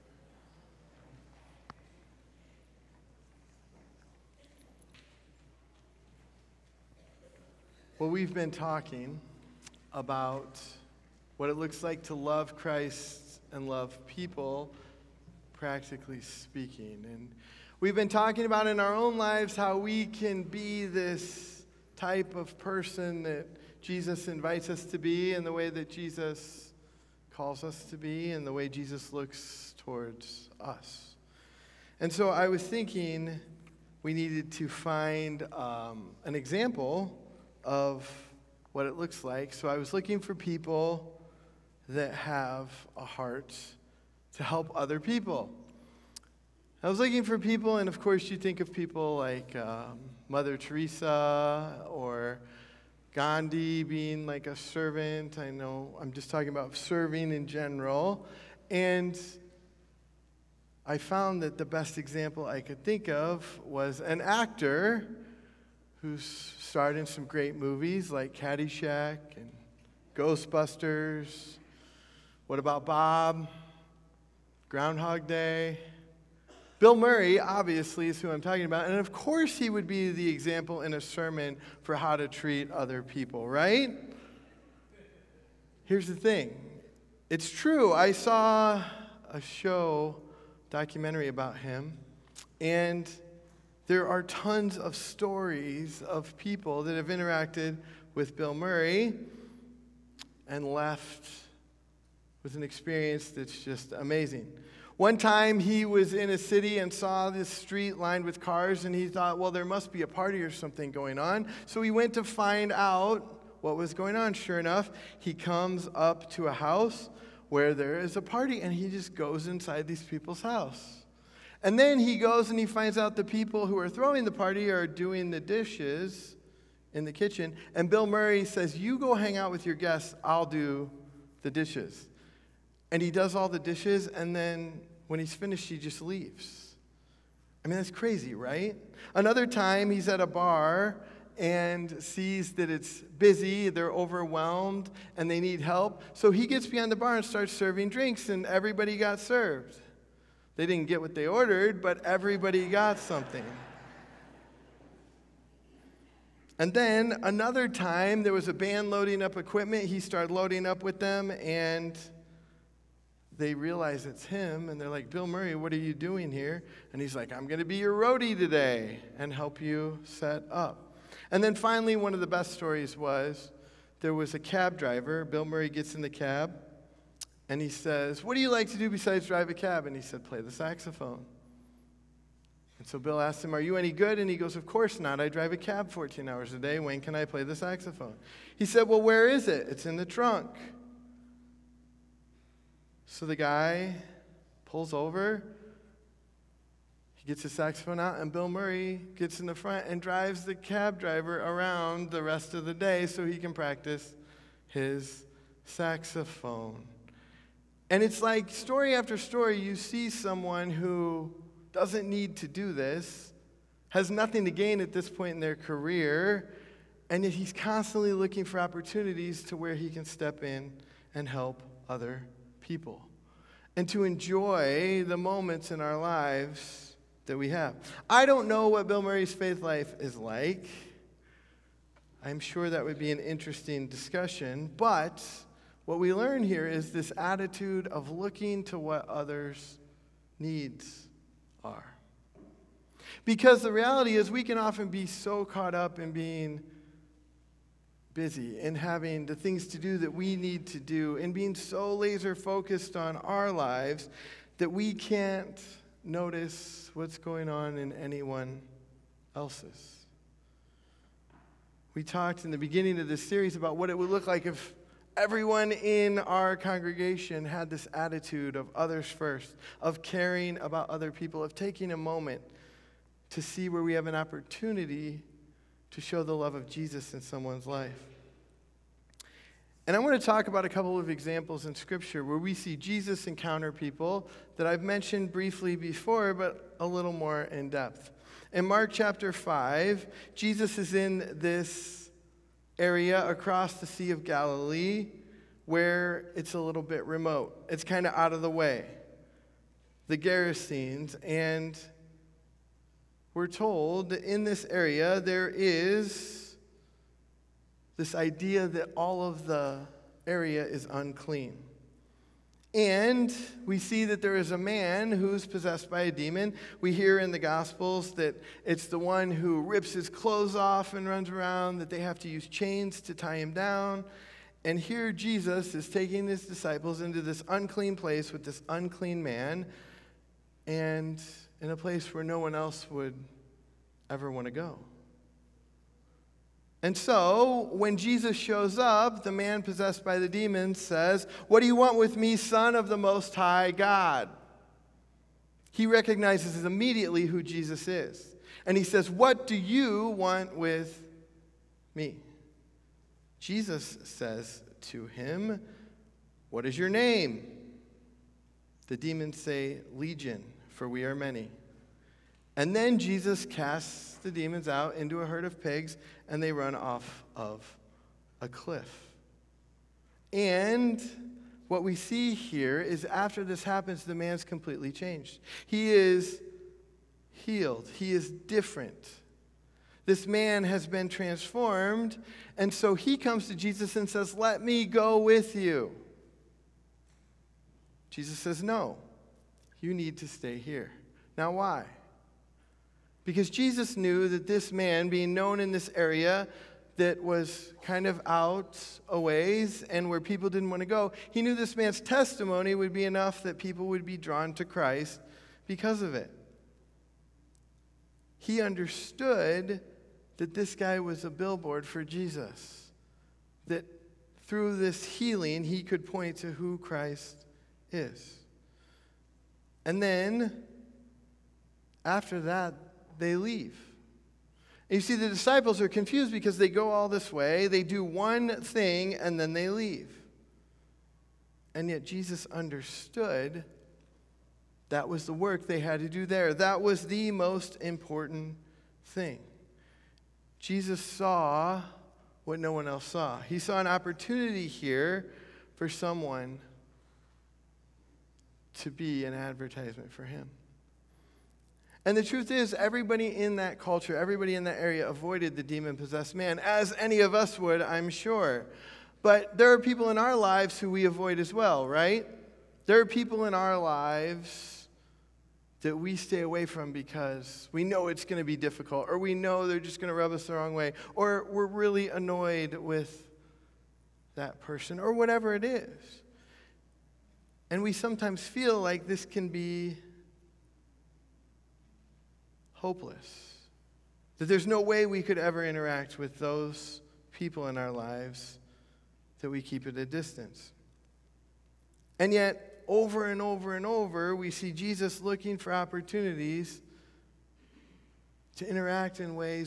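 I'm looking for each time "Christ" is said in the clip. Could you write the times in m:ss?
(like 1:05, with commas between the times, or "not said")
0:12, 6:44, 6:56.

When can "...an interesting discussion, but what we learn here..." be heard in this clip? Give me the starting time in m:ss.
3:53.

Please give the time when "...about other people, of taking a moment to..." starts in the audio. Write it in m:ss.
4:30.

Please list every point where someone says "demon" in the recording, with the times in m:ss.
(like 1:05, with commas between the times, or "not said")
5:16, 5:40, 5:58, 6:04, 7:35.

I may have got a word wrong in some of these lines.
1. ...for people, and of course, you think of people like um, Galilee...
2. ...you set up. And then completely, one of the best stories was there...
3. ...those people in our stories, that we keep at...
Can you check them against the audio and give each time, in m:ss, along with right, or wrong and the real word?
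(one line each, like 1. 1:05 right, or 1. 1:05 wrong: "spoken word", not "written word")
1. 0:47 wrong: "Mother", not "Galilee"
2. 2:49 wrong: "finally", not "completely"
3. 8:06 wrong: "lives", not "stories".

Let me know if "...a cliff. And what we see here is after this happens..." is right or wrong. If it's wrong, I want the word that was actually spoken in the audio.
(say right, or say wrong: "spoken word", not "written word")
right.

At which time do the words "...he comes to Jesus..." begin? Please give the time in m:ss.
6:22.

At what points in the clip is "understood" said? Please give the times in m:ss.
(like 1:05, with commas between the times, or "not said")
6:48, 7:12.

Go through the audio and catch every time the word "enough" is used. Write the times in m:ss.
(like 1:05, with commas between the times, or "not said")
1:54, 6:43.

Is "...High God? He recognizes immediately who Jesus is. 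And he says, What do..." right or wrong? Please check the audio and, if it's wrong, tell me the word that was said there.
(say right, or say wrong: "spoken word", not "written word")
right.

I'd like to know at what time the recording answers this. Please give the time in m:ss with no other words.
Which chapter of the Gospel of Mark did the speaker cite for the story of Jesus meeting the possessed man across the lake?
4:48.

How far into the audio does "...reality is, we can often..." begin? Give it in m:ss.
4:03.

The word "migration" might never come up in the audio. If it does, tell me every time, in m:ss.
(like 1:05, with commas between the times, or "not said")
not said.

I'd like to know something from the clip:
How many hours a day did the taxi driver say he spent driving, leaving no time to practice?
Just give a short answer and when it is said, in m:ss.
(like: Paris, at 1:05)
14, at 3:05.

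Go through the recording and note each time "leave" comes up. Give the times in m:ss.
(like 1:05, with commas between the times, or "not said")
2:16, 7:03, 7:09.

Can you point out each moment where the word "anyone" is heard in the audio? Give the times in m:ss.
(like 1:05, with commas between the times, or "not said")
4:17.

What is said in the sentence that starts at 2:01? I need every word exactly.
And then he goes and he finds out the people who are throwing the party are doing the dishes in the kitchen.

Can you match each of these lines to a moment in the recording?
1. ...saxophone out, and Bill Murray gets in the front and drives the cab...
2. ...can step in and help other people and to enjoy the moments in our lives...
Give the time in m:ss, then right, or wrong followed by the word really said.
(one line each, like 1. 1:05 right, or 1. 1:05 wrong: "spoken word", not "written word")
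1. 3:17 right
2. 3:39 right.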